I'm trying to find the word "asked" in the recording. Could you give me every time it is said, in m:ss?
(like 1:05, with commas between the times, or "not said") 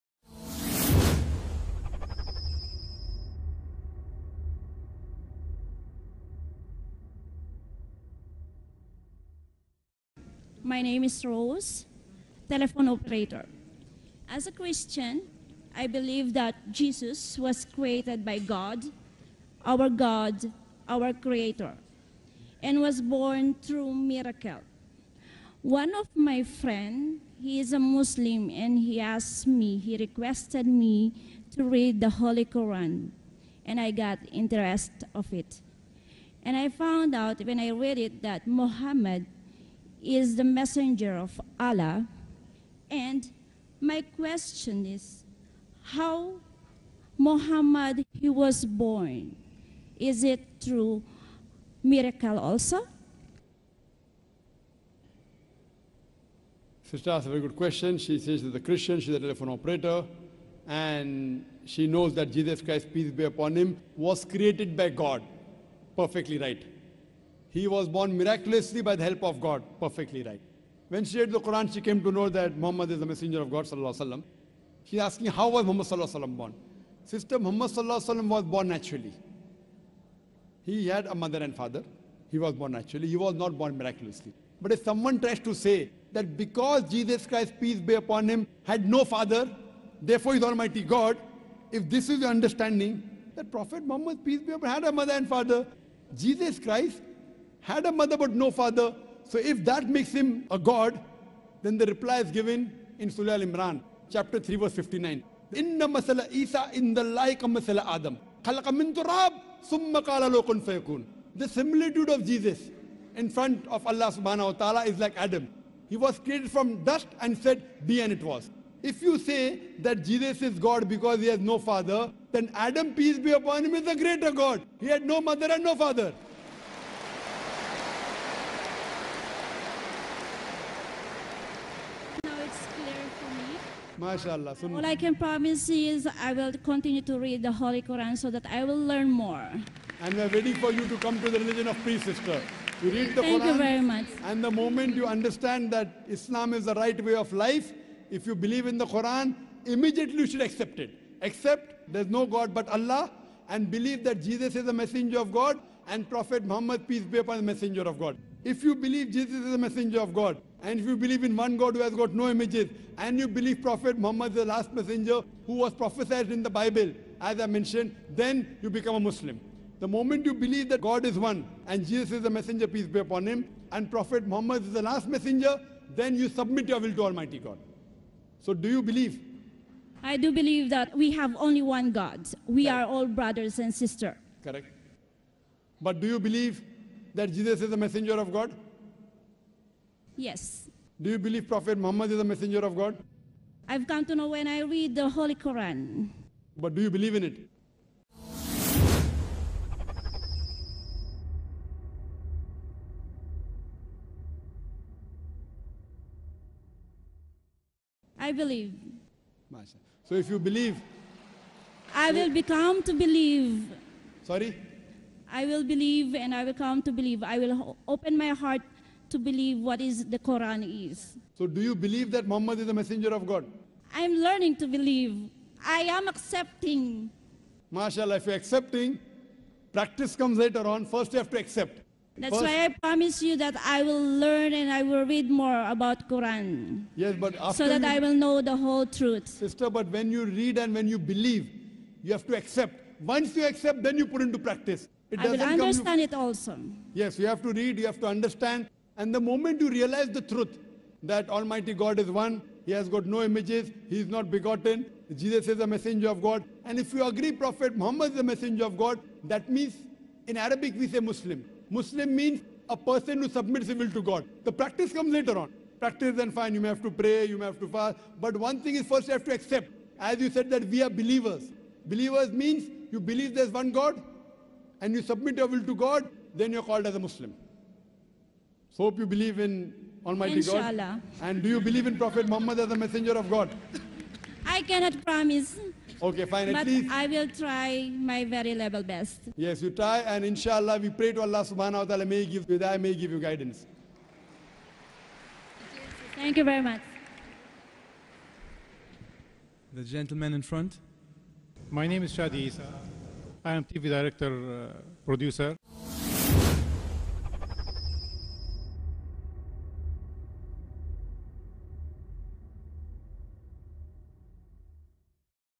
0:29, 0:57.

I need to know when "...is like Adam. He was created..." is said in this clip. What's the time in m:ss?
1:54.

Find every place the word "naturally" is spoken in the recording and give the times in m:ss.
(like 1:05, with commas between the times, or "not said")
1:18, 1:22.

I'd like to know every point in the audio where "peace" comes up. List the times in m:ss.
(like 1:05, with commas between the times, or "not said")
1:02, 1:27, 1:34, 2:02, 2:21, 2:36, 2:52.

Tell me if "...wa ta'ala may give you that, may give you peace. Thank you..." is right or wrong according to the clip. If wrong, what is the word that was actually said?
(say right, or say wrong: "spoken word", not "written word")
wrong: "guidance", not "peace".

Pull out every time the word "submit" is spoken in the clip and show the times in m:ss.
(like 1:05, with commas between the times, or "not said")
2:56, 4:23, 4:35.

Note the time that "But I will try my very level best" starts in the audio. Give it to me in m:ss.
4:46.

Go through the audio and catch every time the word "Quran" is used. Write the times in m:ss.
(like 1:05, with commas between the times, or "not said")
0:32, 1:11, 2:17, 2:23, 2:28, 3:15, 3:40, 3:56.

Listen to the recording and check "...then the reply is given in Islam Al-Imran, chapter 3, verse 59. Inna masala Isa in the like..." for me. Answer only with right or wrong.
wrong.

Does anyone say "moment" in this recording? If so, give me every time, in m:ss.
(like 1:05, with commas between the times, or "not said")
2:24, 2:49, 4:09.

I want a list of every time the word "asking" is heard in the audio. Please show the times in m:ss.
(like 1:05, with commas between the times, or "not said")
1:14.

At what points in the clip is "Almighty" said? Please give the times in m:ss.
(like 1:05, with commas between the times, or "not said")
1:30, 2:57, 4:11, 4:40.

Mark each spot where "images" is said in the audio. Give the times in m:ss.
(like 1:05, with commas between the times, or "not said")
2:42, 4:13.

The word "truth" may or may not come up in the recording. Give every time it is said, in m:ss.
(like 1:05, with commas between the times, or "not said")
3:58, 4:10.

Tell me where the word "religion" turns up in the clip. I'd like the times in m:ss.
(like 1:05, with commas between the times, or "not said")
2:21.